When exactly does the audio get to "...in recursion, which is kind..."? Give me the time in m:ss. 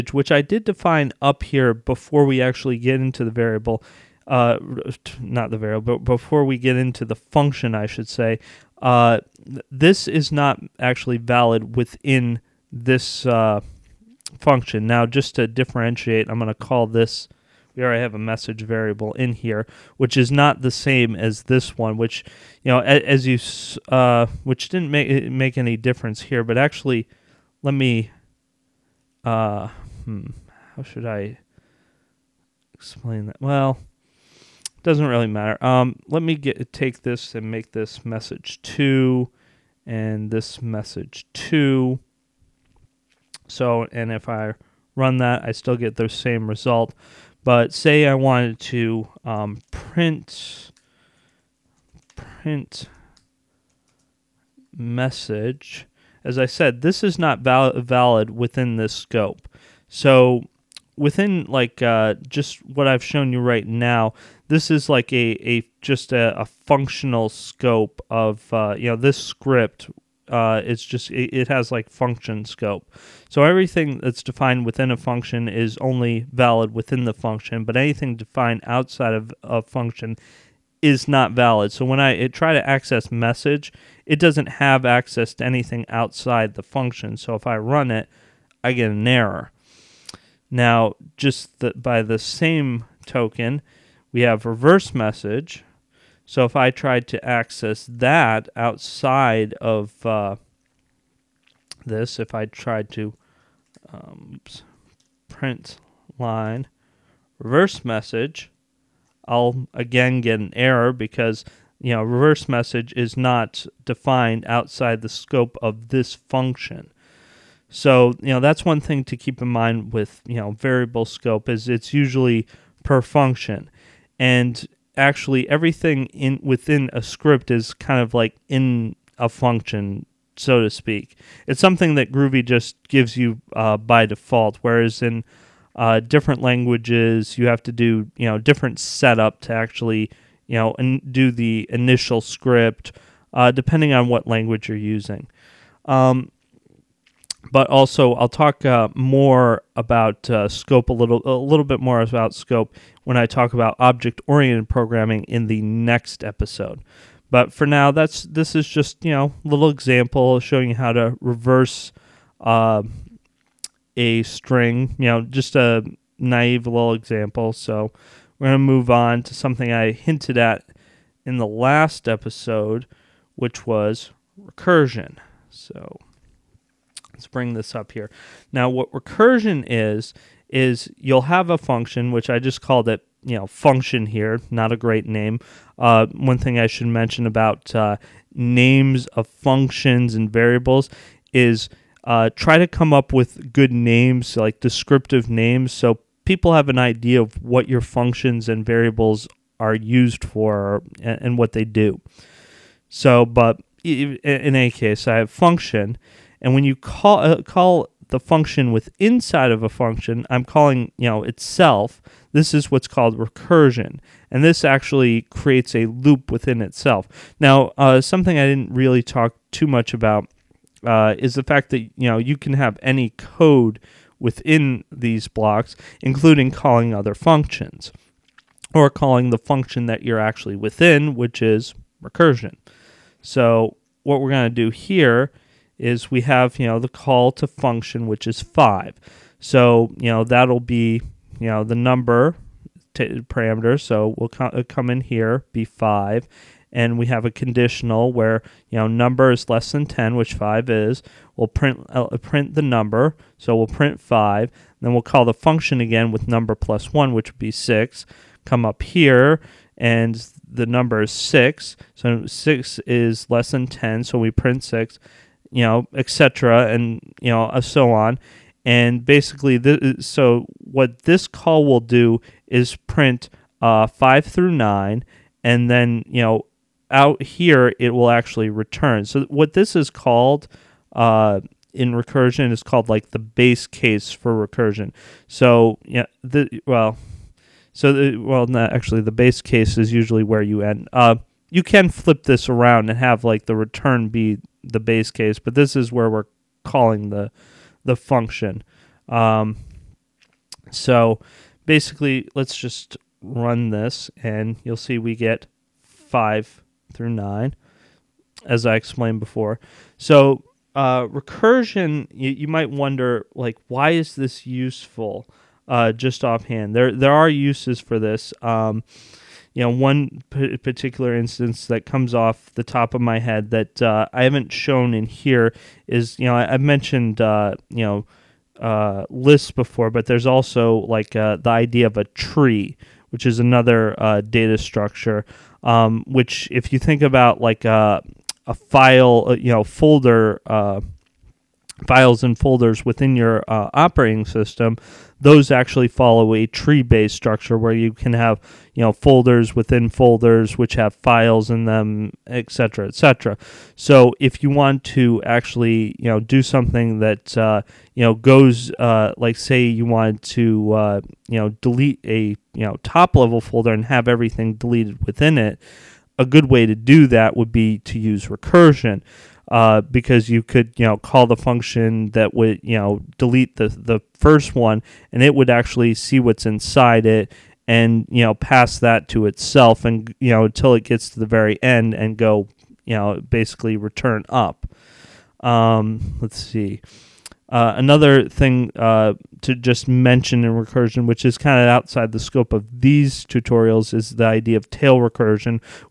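6:30.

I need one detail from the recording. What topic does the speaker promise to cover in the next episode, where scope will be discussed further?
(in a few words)
object oriented programming.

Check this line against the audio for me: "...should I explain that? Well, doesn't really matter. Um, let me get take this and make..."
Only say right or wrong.
right.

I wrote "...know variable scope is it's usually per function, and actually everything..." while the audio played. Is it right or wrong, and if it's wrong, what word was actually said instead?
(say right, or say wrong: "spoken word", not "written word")
right.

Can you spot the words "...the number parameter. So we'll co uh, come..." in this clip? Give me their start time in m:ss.
4:01.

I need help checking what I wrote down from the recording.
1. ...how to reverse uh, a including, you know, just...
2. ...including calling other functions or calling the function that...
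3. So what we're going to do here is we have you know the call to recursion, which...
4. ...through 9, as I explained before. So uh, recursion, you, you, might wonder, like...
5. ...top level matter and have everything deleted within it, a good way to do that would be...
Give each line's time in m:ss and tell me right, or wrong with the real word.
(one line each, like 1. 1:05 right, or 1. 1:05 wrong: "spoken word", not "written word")
1. 2:40 wrong: "string", not "including"
2. 3:46 right
3. 3:53 wrong: "function", not "recursion"
4. 5:06 right
5. 6:02 wrong: "folder", not "matter".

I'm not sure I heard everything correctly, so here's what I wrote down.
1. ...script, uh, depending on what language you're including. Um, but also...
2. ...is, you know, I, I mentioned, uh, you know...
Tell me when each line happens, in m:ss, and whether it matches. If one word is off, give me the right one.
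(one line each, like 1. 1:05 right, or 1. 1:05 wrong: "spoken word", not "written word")
1. 2:22 wrong: "using", not "including"
2. 5:25 right.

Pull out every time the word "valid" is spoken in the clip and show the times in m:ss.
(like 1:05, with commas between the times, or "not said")
0:11, 0:57, 1:16, 1:21.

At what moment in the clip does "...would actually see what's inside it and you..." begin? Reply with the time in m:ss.
6:15.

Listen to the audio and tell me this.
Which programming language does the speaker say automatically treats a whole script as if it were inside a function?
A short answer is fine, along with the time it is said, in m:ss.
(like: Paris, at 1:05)
Groovy, at 2:12.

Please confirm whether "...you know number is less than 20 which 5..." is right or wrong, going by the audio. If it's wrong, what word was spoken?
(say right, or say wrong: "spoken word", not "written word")
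wrong: "10", not "20".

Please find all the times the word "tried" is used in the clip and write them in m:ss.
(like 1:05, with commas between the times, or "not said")
1:36, 1:42.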